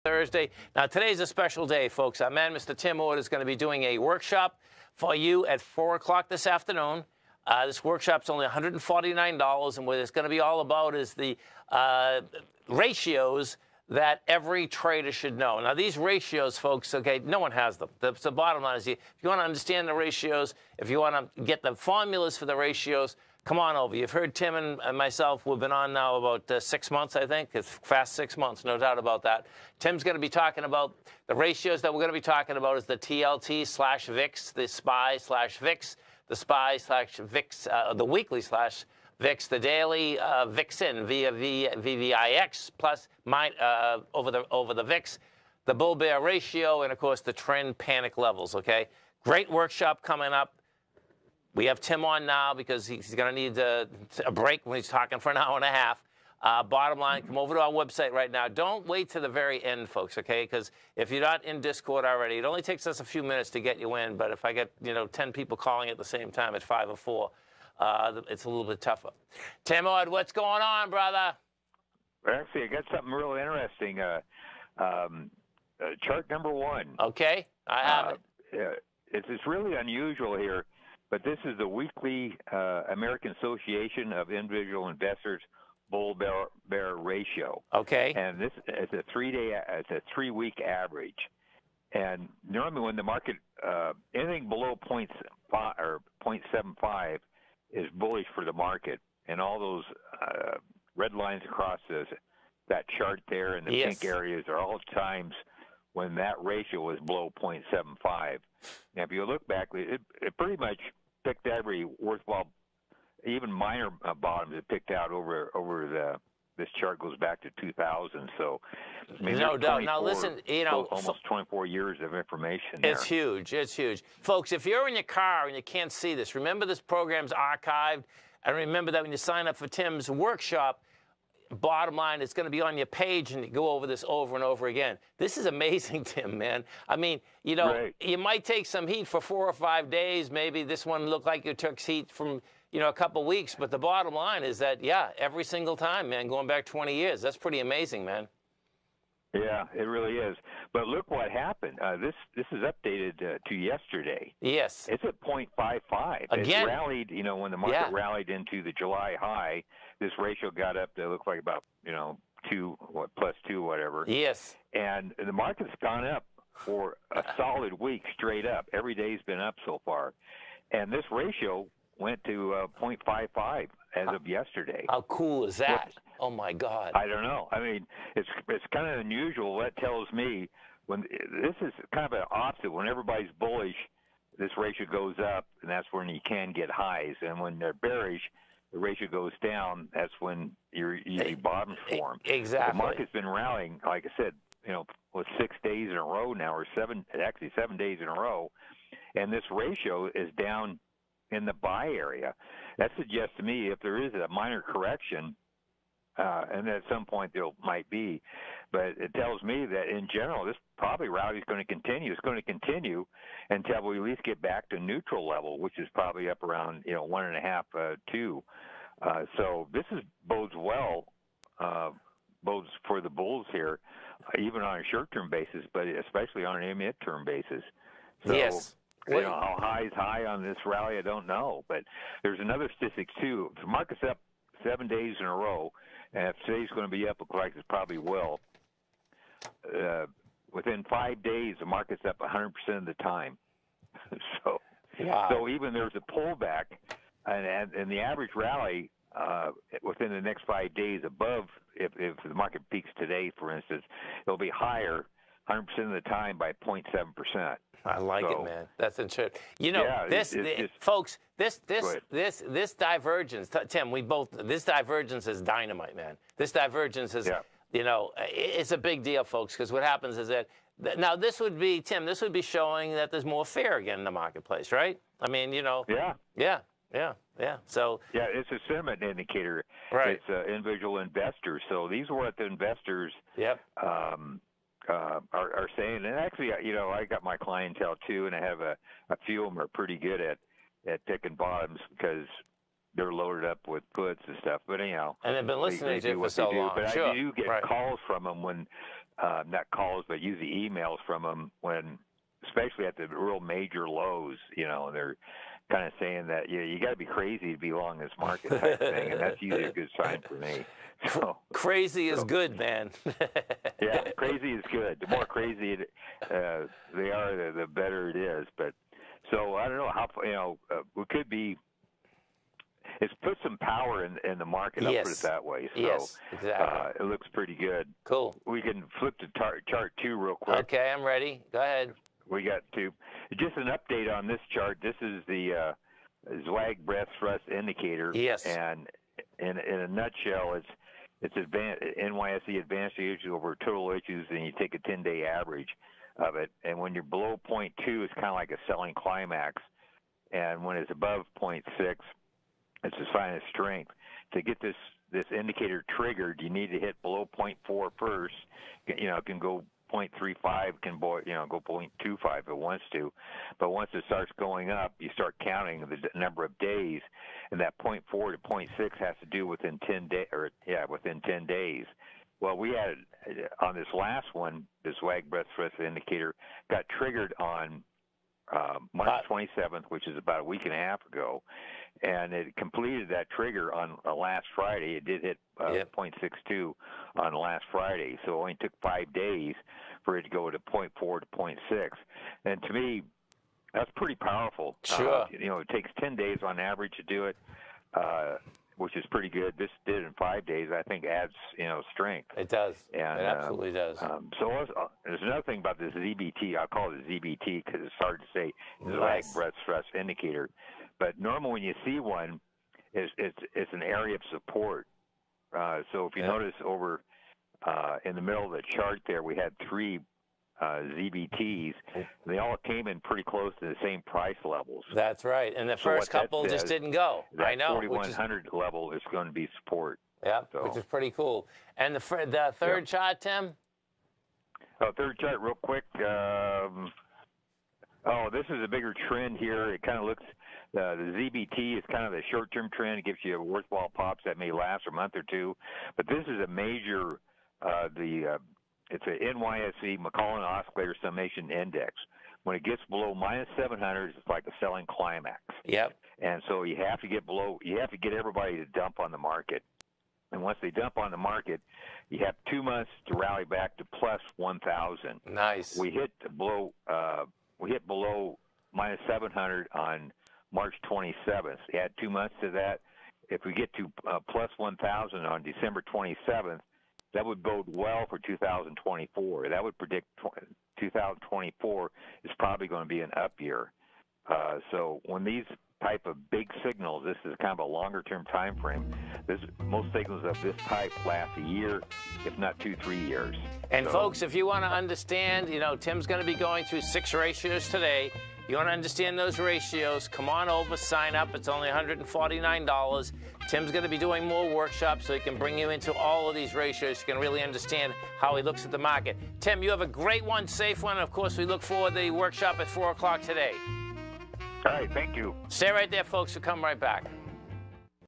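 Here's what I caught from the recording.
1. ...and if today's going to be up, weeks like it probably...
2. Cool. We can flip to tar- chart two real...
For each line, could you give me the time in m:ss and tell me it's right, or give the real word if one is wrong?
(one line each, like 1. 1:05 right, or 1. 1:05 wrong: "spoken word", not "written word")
1. 3:56 wrong: "looks", not "weeks"
2. 5:28 right.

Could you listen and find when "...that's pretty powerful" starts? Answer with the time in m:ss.
6:33.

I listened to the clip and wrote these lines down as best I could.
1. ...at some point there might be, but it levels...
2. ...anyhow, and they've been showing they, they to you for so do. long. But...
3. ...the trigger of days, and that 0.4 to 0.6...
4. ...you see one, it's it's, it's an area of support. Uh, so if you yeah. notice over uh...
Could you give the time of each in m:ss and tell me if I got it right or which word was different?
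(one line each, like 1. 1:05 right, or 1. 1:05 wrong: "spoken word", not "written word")
1. 3:26 wrong: "tells", not "levels"
2. 4:54 wrong: "listening", not "showing"
3. 6:05 wrong: "number", not "trigger"
4. 6:51 right.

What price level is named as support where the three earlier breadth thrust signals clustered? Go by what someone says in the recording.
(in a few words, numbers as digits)
4100.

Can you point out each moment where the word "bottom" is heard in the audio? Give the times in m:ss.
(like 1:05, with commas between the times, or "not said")
0:18, 0:56, 1:54, 2:11, 2:23, 3:11, 4:51.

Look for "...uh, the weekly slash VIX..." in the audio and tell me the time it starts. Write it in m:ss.
0:37.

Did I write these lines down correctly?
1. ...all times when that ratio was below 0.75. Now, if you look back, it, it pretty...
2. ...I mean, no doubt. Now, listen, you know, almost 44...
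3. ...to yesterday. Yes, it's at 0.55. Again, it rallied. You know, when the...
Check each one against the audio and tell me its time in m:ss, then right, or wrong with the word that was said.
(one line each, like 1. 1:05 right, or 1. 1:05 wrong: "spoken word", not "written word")
1. 1:44 right
2. 1:59 wrong: "24", not "44"
3. 2:33 right.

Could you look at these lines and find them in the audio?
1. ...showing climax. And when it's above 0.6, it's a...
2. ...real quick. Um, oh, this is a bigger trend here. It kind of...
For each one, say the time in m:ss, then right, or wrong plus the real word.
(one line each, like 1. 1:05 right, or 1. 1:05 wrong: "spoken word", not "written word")
1. 5:48 wrong: "selling", not "showing"
2. 7:15 right.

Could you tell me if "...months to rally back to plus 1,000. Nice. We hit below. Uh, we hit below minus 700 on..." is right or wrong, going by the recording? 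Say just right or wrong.
right.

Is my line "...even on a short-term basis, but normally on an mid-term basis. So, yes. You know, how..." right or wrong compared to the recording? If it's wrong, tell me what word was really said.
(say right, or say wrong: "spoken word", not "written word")
wrong: "especially", not "normally".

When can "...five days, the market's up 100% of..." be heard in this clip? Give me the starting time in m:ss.
4:00.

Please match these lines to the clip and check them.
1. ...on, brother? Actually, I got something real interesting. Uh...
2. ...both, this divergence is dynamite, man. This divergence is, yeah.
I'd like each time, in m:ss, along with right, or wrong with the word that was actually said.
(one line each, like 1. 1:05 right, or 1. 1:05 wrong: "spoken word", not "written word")
1. 1:10 right
2. 4:24 right.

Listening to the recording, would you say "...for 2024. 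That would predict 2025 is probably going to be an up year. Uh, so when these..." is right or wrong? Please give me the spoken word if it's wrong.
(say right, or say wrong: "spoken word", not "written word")
wrong: "2024", not "2025".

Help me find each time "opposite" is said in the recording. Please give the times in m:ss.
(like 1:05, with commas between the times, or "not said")
3:02.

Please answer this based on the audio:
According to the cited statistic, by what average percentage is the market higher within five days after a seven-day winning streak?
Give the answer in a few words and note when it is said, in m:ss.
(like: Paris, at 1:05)
0.7%, at 4:16.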